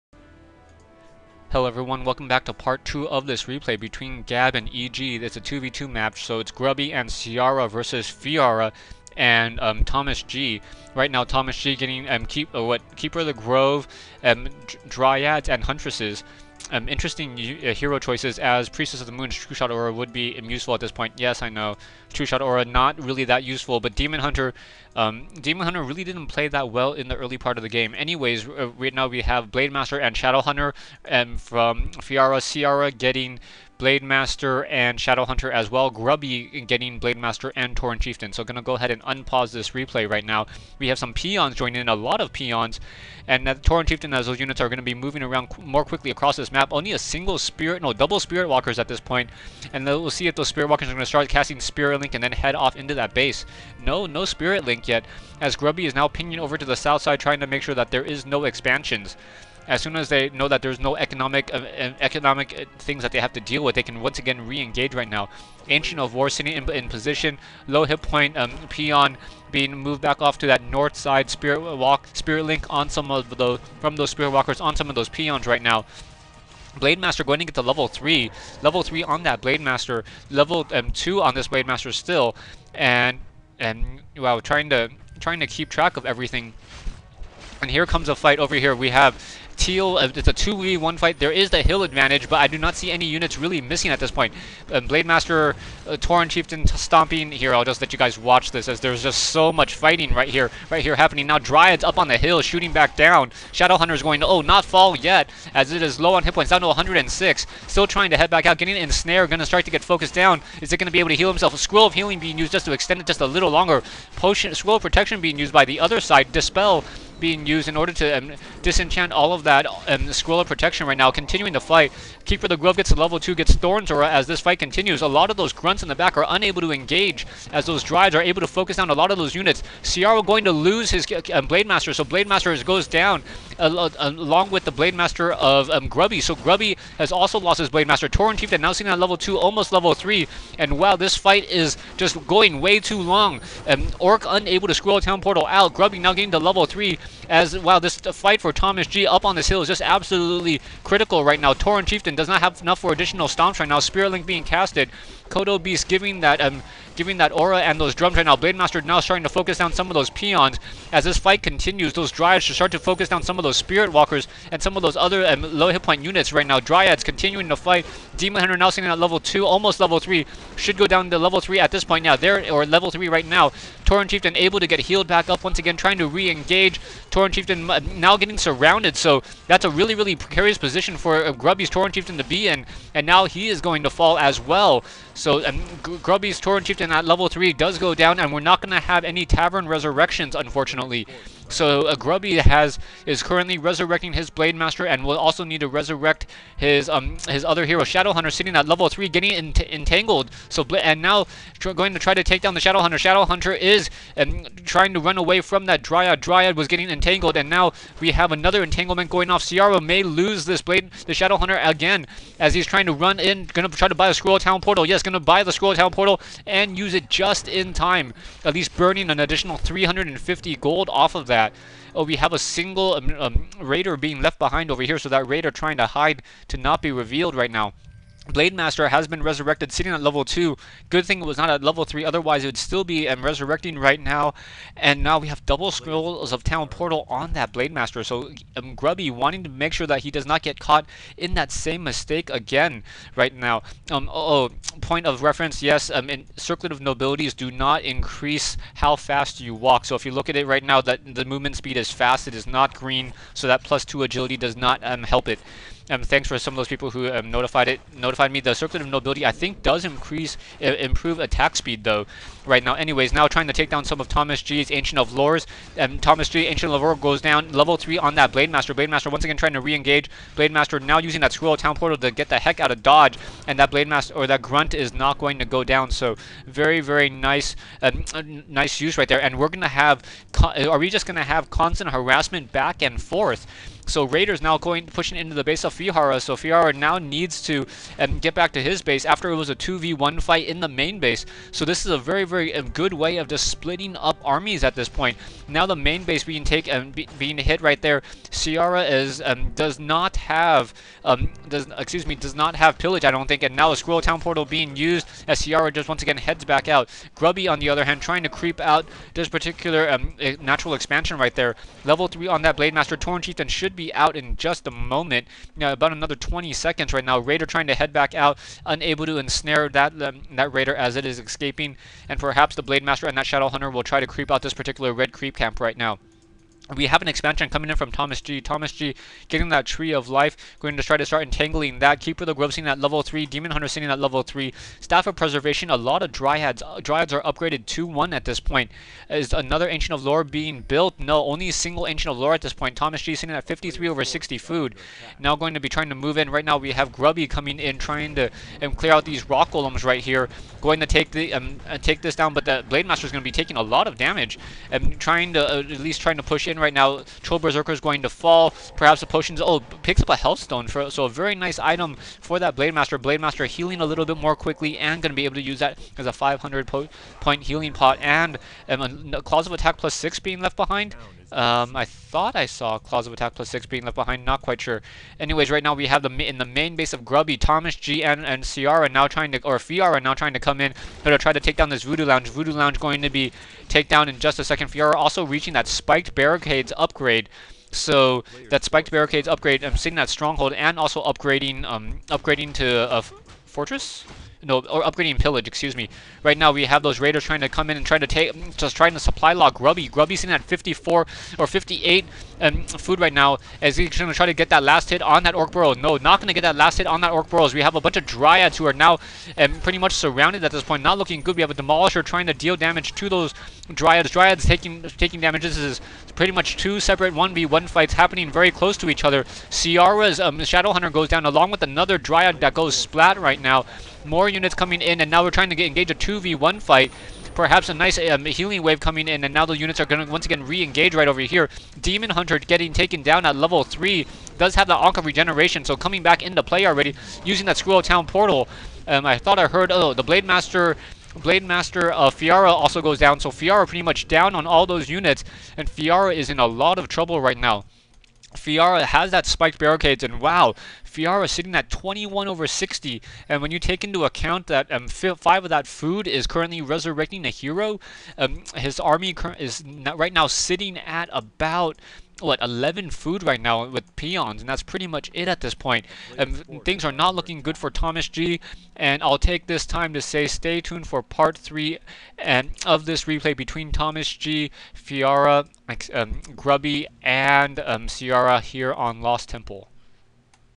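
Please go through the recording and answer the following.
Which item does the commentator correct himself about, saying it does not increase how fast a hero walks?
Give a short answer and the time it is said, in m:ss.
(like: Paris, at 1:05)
Circlet of Nobility, at 4:18.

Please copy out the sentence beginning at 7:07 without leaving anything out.
Perhaps a nice um, healing wave coming in, and now the units are going to once again re-engage right over here.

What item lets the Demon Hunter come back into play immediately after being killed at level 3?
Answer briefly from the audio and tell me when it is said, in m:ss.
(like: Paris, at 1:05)
Ankh of Regeneration, at 7:14.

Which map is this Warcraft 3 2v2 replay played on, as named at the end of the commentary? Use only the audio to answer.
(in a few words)
Lost Temple.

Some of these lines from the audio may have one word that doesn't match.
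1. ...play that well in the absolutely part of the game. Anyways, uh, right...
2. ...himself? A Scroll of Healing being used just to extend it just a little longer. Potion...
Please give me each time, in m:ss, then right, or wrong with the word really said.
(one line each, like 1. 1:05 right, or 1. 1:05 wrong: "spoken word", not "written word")
1. 0:26 wrong: "early", not "absolutely"
2. 1:51 right.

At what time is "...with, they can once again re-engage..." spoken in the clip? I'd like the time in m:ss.
1:03.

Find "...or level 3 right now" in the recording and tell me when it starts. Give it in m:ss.
2:52.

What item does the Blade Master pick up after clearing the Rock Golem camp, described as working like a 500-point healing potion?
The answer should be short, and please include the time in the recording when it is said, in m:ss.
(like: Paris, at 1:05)
Health stone, at 6:00.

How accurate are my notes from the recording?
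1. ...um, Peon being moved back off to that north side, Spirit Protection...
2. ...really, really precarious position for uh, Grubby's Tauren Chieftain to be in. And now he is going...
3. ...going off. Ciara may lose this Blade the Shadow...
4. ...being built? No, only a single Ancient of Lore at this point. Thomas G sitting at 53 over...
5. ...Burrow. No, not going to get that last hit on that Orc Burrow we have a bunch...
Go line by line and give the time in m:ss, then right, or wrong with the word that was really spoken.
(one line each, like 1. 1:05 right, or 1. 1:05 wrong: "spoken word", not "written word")
1. 1:08 wrong: "Walk", not "Protection"
2. 2:59 right
3. 3:29 right
4. 5:40 right
5. 6:45 right.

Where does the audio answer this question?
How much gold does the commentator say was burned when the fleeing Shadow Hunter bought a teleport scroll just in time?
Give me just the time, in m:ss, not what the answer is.
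3:39.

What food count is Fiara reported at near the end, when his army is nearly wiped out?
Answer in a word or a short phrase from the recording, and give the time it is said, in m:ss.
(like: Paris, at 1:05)
21 over 60, at 7:31.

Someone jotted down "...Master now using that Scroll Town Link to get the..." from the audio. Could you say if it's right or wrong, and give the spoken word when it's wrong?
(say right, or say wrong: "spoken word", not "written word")
wrong: "Portal", not "Link".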